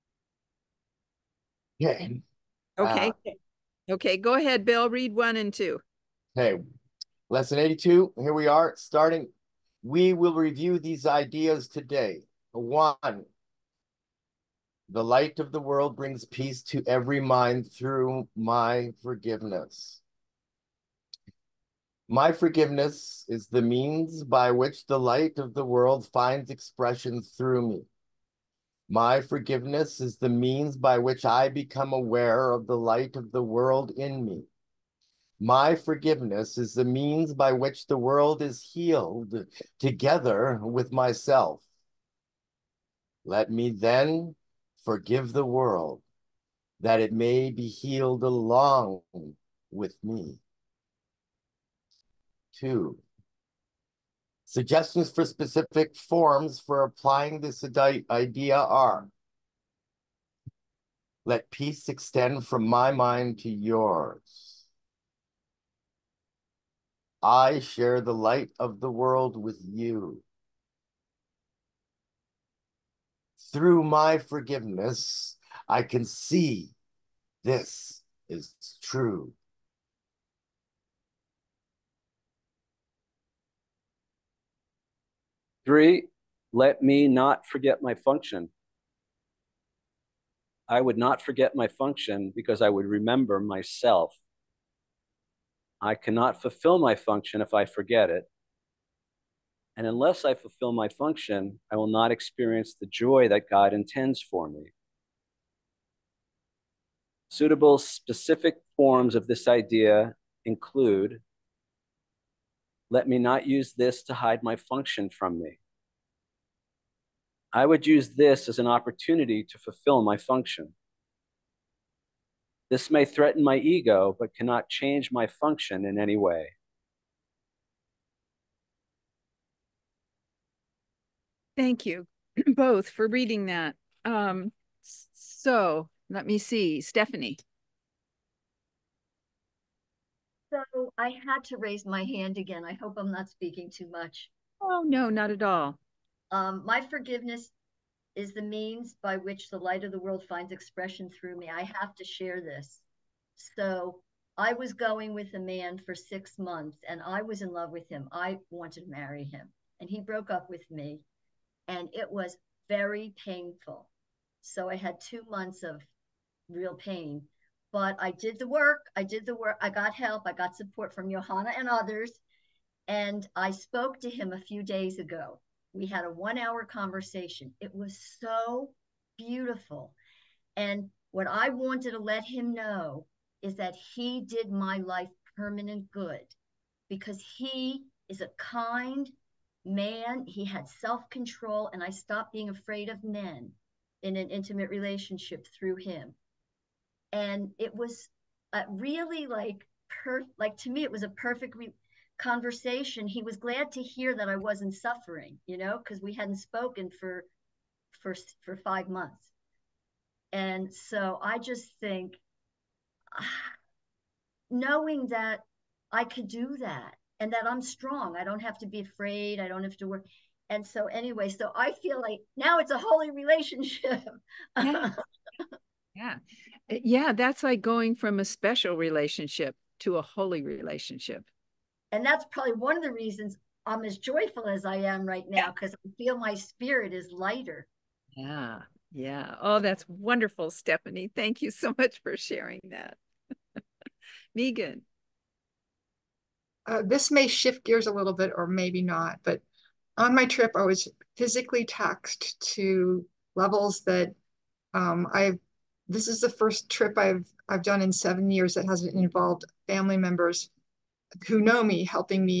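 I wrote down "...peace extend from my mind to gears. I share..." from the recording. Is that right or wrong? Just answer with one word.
wrong.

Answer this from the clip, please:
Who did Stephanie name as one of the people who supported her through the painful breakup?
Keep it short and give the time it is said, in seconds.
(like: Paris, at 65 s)
Johanna, at 171 s.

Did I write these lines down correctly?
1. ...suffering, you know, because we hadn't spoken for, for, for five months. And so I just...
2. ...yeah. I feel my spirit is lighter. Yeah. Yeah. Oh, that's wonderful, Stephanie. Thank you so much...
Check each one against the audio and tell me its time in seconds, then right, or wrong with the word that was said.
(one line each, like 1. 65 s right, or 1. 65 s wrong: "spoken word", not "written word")
1. 204 s right
2. 235 s right.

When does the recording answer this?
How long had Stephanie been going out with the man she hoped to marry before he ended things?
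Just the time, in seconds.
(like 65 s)
155 s.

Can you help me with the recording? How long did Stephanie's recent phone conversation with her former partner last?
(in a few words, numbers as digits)
1 hour.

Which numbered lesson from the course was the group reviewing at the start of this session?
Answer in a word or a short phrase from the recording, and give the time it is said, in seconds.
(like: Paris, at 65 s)
82, at 7 s.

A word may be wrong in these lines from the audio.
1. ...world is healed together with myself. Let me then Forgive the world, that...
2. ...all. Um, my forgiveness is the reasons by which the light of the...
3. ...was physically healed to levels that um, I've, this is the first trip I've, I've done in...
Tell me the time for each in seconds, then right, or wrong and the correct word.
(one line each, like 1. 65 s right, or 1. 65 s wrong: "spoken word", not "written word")
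1. 37 s right
2. 145 s wrong: "means", not "reasons"
3. 250 s wrong: "taxed", not "healed".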